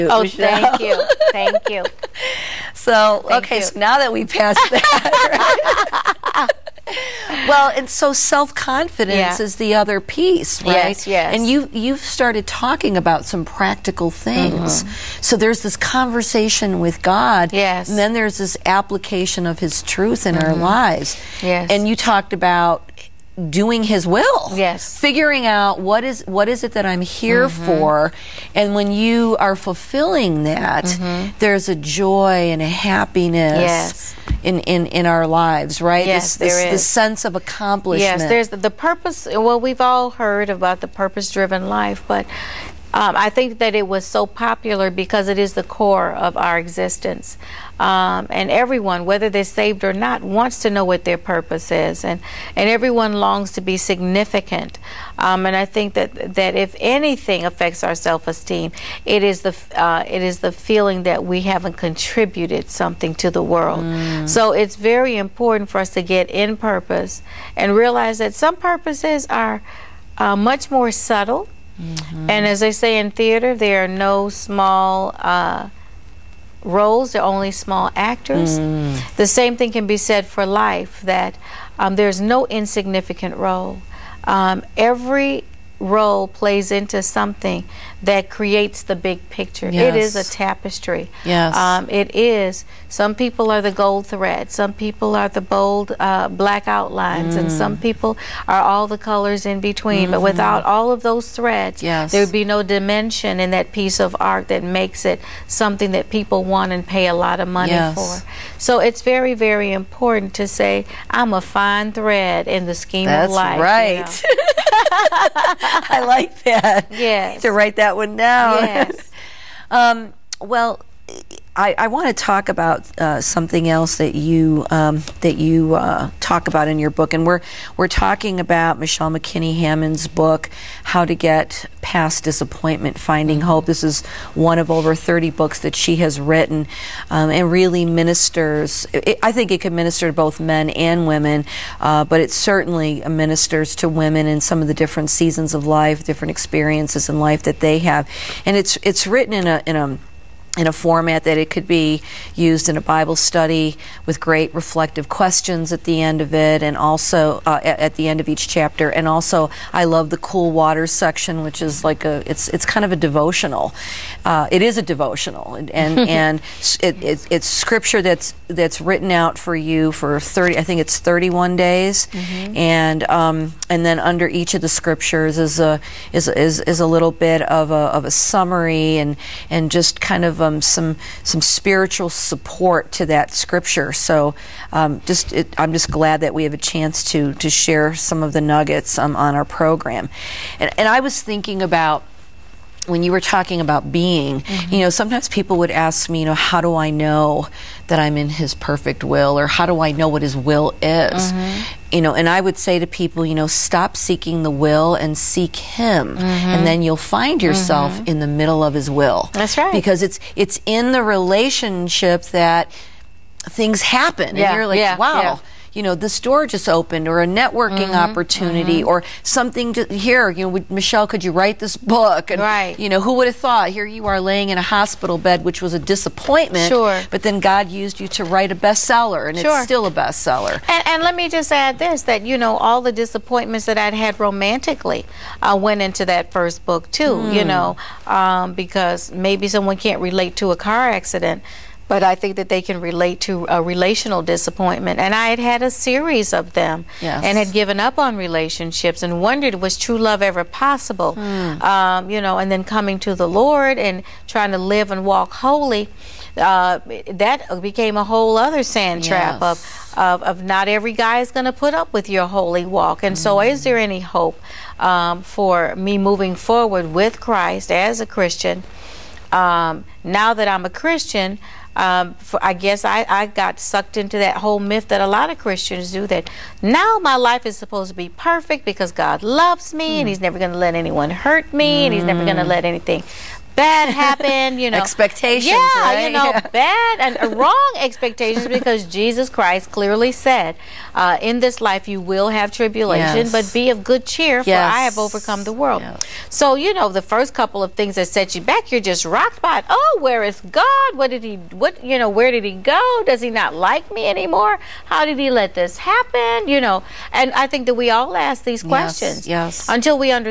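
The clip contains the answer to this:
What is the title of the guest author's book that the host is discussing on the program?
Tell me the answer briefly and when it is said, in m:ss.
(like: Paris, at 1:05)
How to Get Past Disappointment, at 2:10.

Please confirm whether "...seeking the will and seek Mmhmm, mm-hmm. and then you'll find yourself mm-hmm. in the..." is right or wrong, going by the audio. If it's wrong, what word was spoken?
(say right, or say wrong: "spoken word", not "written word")
wrong: "Him", not "Mmhmm".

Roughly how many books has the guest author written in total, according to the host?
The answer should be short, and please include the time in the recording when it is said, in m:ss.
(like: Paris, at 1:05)
over 30, at 2:14.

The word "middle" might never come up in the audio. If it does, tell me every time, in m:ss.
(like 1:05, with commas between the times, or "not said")
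3:28.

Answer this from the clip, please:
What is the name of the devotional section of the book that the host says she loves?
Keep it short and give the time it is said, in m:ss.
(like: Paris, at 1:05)
cool water, at 2:40.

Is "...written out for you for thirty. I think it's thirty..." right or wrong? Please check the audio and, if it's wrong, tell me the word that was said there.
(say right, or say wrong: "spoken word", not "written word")
right.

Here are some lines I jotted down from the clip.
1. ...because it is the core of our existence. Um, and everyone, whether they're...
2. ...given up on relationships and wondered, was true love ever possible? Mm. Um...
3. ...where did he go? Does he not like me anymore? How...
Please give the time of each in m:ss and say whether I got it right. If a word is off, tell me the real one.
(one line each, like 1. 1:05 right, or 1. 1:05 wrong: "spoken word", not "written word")
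1. 0:44 right
2. 4:07 right
3. 5:02 right.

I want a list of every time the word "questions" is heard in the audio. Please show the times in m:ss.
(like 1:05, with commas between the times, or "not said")
2:35, 5:08.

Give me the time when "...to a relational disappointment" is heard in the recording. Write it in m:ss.
4:03.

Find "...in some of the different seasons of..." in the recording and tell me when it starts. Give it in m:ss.
2:24.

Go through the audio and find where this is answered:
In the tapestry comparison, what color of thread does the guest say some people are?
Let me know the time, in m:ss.
1:33.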